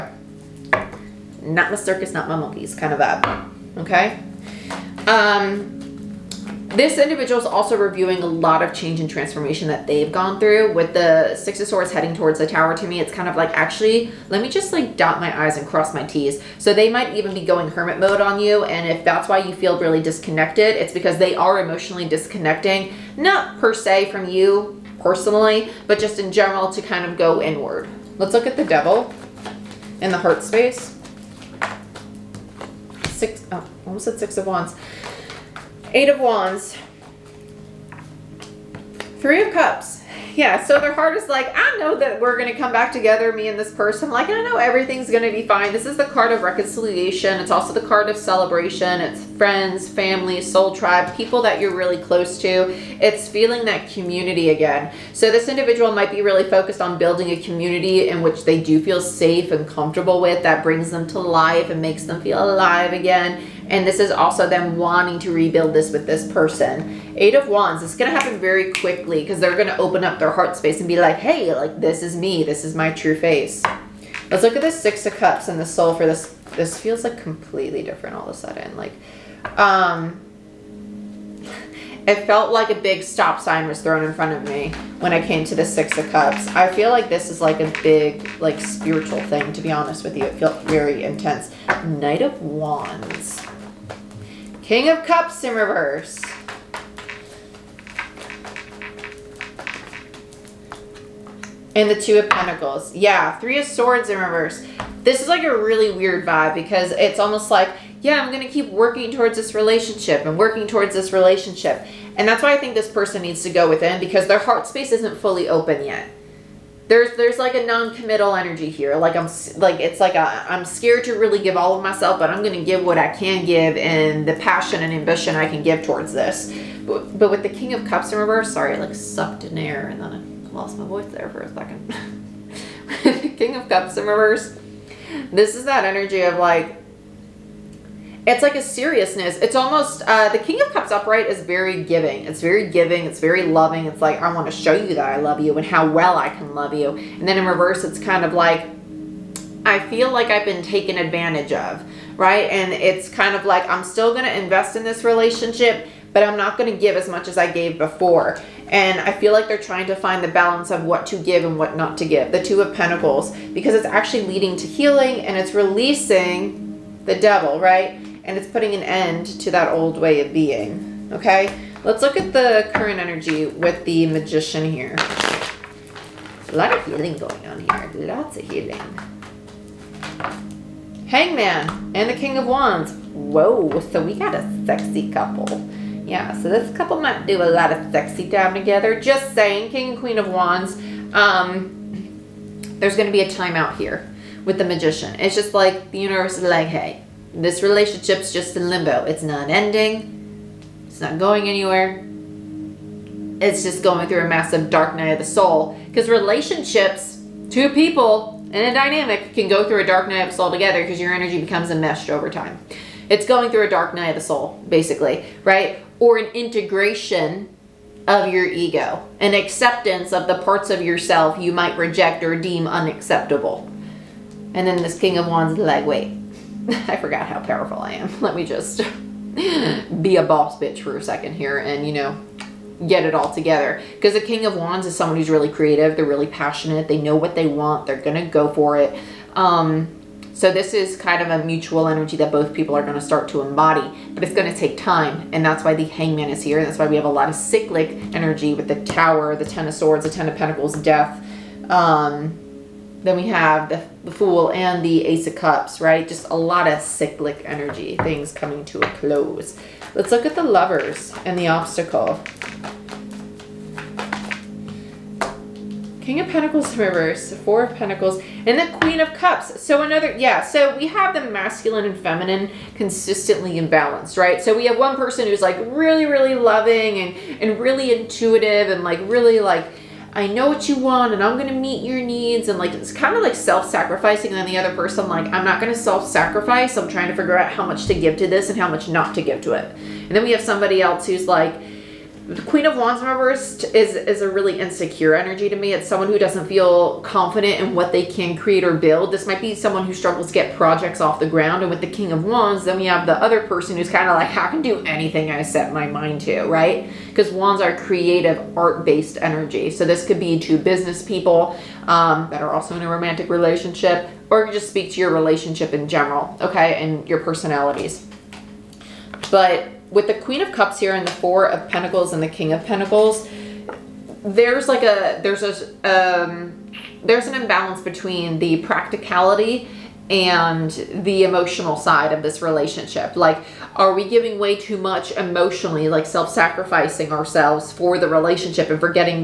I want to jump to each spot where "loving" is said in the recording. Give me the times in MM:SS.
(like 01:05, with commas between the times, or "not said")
02:23, 04:36.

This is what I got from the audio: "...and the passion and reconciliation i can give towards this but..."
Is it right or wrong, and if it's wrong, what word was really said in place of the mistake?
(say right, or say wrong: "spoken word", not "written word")
wrong: "ambition", not "reconciliation".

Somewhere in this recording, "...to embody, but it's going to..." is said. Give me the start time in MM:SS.
04:03.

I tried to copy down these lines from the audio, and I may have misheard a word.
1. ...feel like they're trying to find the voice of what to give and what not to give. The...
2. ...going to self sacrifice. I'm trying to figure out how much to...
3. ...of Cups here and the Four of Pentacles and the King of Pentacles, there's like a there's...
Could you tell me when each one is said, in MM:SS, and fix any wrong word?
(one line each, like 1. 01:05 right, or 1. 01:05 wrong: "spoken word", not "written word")
1. 02:39 wrong: "balance", not "voice"
2. 04:45 right
3. 05:20 right.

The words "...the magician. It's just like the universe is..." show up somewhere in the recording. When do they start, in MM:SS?
03:14.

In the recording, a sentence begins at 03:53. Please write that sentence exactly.
Because the King of Wands is someone who's really creative.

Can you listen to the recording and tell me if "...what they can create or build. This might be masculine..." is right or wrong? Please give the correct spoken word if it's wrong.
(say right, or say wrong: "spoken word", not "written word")
wrong: "someone", not "masculine".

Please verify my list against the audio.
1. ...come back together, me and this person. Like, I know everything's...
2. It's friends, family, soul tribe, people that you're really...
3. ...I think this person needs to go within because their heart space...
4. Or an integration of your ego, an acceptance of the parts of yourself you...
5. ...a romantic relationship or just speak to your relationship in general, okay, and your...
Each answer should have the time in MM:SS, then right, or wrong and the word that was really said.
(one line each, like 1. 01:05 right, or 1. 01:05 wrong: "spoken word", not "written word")
1. 00:42 right
2. 00:49 right
3. 01:52 right
4. 03:35 right
5. 05:12 right.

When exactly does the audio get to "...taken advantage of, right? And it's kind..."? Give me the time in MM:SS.
02:30.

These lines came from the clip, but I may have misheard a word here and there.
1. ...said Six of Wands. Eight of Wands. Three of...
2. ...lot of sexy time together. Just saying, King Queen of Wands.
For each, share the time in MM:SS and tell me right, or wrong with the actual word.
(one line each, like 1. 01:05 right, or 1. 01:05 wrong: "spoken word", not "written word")
1. 00:34 right
2. 03:07 right.